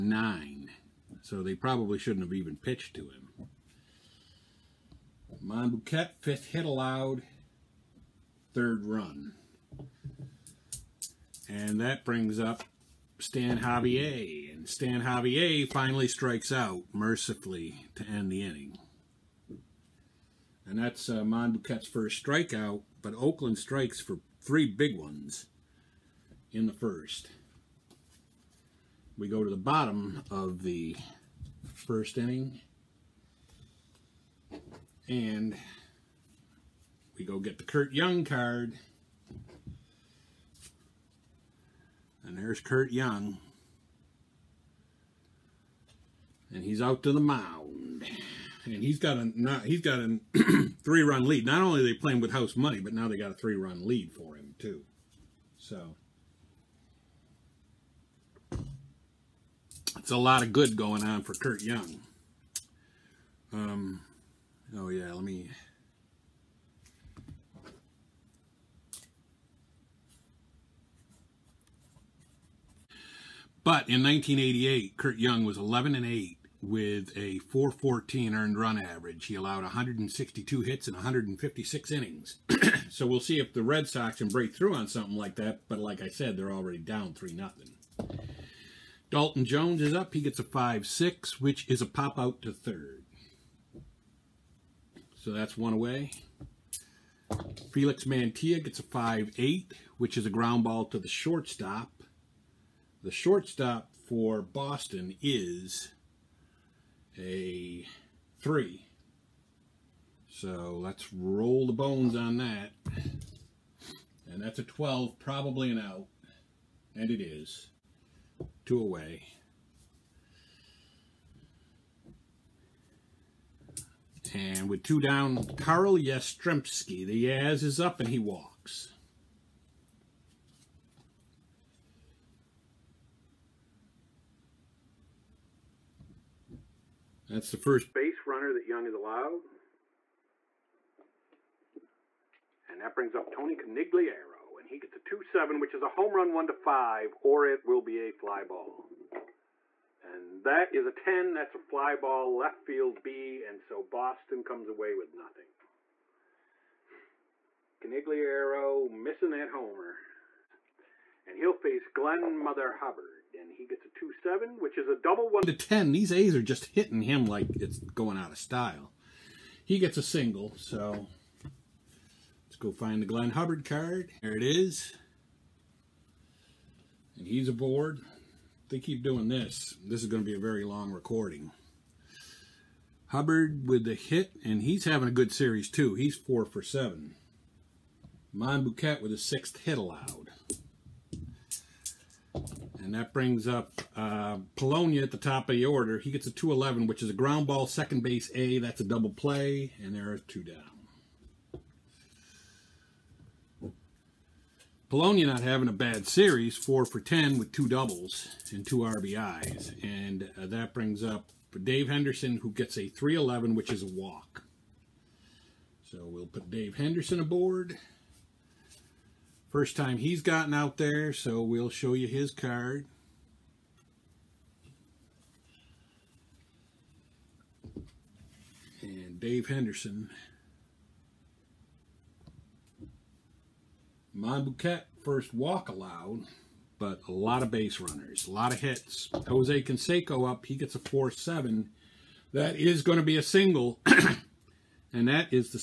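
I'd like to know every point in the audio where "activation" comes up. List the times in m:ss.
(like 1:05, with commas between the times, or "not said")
not said.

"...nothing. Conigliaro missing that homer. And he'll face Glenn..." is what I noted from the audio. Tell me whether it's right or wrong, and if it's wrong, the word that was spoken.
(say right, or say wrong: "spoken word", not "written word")
right.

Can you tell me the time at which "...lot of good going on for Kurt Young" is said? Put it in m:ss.
1:00.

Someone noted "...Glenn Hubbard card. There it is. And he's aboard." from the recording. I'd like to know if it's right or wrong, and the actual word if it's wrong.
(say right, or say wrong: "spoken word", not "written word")
right.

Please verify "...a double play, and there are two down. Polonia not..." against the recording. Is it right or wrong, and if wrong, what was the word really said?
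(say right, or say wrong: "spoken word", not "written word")
right.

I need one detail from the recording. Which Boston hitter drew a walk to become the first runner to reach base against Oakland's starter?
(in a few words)
Karl Yastrzemski.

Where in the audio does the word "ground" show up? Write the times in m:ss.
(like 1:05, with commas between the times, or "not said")
1:40, 3:17.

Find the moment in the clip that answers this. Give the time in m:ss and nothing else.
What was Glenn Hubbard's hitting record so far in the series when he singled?
3:06.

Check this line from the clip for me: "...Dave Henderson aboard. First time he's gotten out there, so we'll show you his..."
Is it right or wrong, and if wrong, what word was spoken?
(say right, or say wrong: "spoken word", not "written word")
right.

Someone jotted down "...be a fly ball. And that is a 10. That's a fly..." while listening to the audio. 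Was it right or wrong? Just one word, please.
right.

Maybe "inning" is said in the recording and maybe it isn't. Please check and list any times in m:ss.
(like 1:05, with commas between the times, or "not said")
0:18, 0:32, 1:21.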